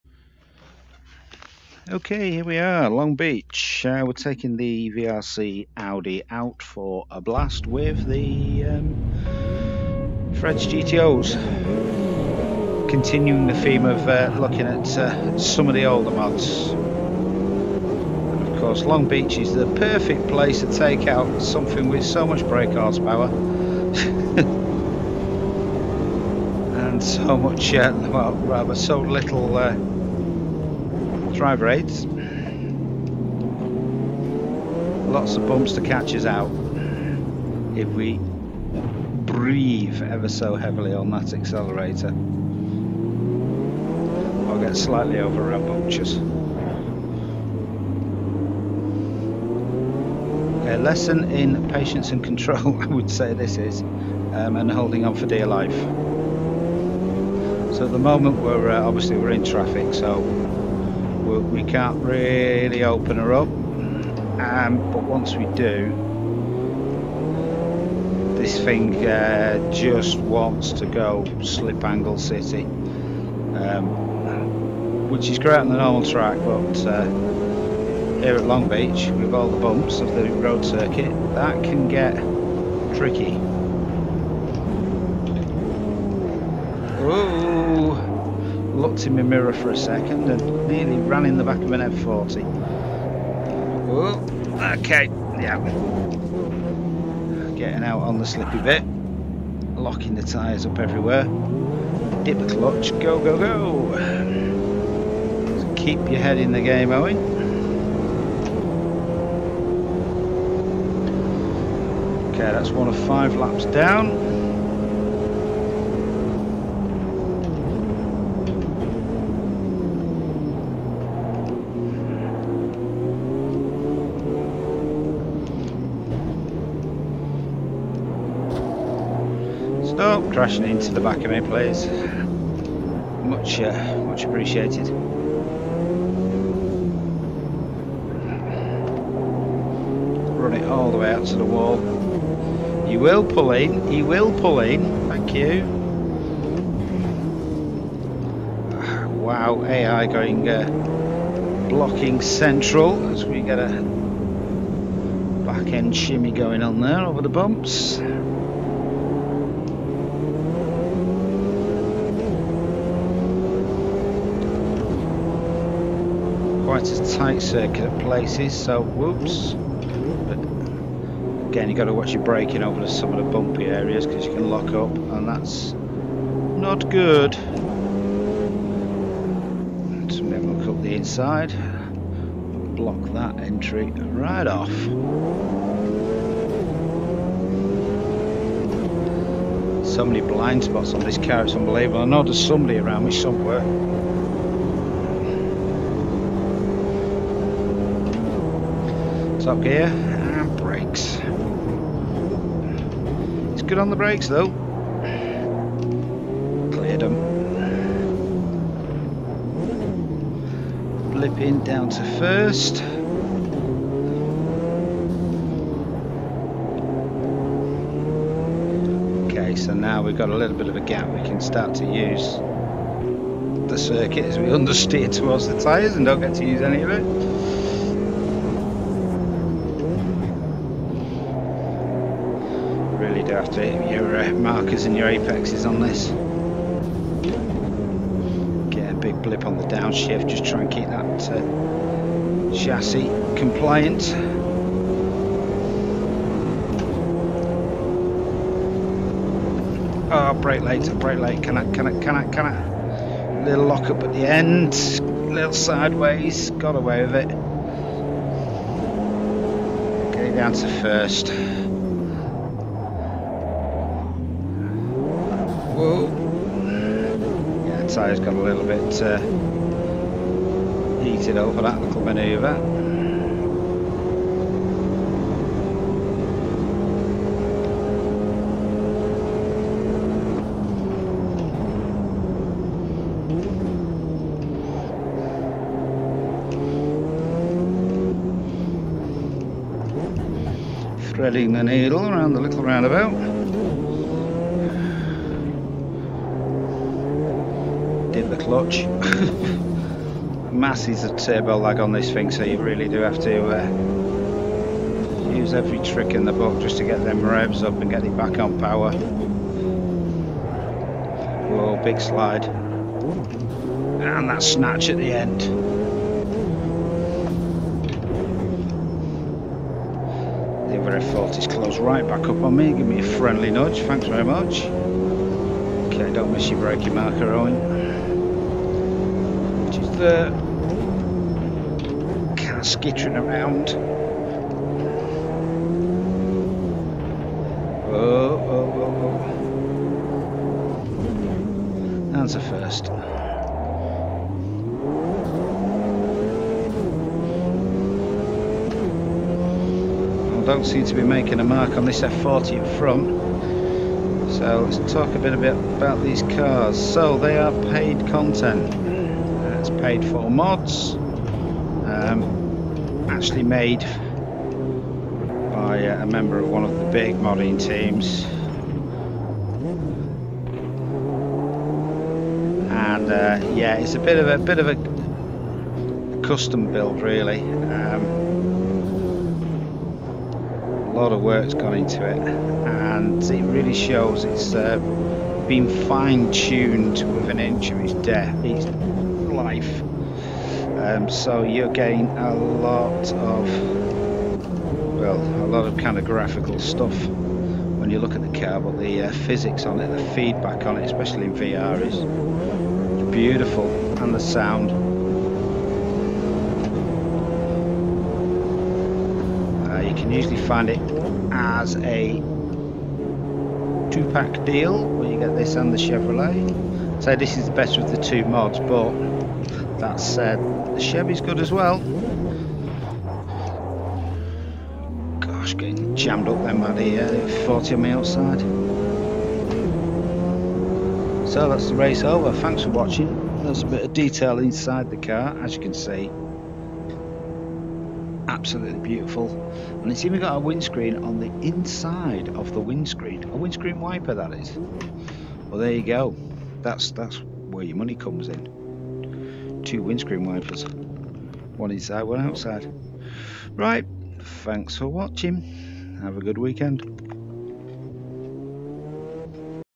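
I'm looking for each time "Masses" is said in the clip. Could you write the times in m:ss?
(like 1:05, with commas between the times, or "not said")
5:00.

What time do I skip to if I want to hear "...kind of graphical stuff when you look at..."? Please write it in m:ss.
6:35.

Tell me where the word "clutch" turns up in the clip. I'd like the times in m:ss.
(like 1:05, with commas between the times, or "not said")
1:42, 4:58.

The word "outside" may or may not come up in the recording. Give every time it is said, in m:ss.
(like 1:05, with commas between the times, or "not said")
7:07, 7:32.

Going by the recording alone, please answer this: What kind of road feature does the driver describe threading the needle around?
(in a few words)
roundabout.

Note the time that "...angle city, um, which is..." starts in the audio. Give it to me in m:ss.
1:11.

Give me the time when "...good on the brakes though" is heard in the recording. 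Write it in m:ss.
3:23.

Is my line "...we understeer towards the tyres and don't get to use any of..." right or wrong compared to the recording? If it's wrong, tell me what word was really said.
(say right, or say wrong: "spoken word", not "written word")
right.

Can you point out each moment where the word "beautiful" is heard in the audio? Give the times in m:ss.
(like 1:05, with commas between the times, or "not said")
6:43, 7:18.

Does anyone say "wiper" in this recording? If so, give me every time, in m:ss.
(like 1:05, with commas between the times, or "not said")
7:23, 7:30.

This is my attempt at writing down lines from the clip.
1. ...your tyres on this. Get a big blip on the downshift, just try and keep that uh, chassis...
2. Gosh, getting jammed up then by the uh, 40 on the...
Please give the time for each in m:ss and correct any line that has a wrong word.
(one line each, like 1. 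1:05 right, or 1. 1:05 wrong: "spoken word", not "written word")
1. 3:54 wrong: "apexes", not "tyres"
2. 7:05 right.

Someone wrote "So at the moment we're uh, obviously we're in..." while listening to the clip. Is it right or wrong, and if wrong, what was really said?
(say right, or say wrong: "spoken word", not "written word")
right.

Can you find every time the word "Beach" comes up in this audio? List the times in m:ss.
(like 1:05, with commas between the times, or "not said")
0:03, 0:19, 1:18.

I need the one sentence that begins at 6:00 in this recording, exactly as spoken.
Um, actually made by a member of one of the big modding teams.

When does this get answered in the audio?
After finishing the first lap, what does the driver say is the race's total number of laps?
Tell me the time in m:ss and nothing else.
1:53.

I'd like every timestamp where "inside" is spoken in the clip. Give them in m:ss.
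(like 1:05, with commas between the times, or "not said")
3:00, 7:14, 7:21, 7:31.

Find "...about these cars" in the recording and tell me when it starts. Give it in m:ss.
5:55.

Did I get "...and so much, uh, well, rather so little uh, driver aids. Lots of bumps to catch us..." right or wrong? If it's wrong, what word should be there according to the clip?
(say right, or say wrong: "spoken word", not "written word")
right.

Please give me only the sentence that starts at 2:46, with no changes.
quite a tight circuit at places, so whoops.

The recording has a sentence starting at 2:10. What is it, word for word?
Oh, crashing into the back of me, please.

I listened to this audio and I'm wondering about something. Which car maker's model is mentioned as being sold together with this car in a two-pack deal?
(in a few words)
Chevrolet.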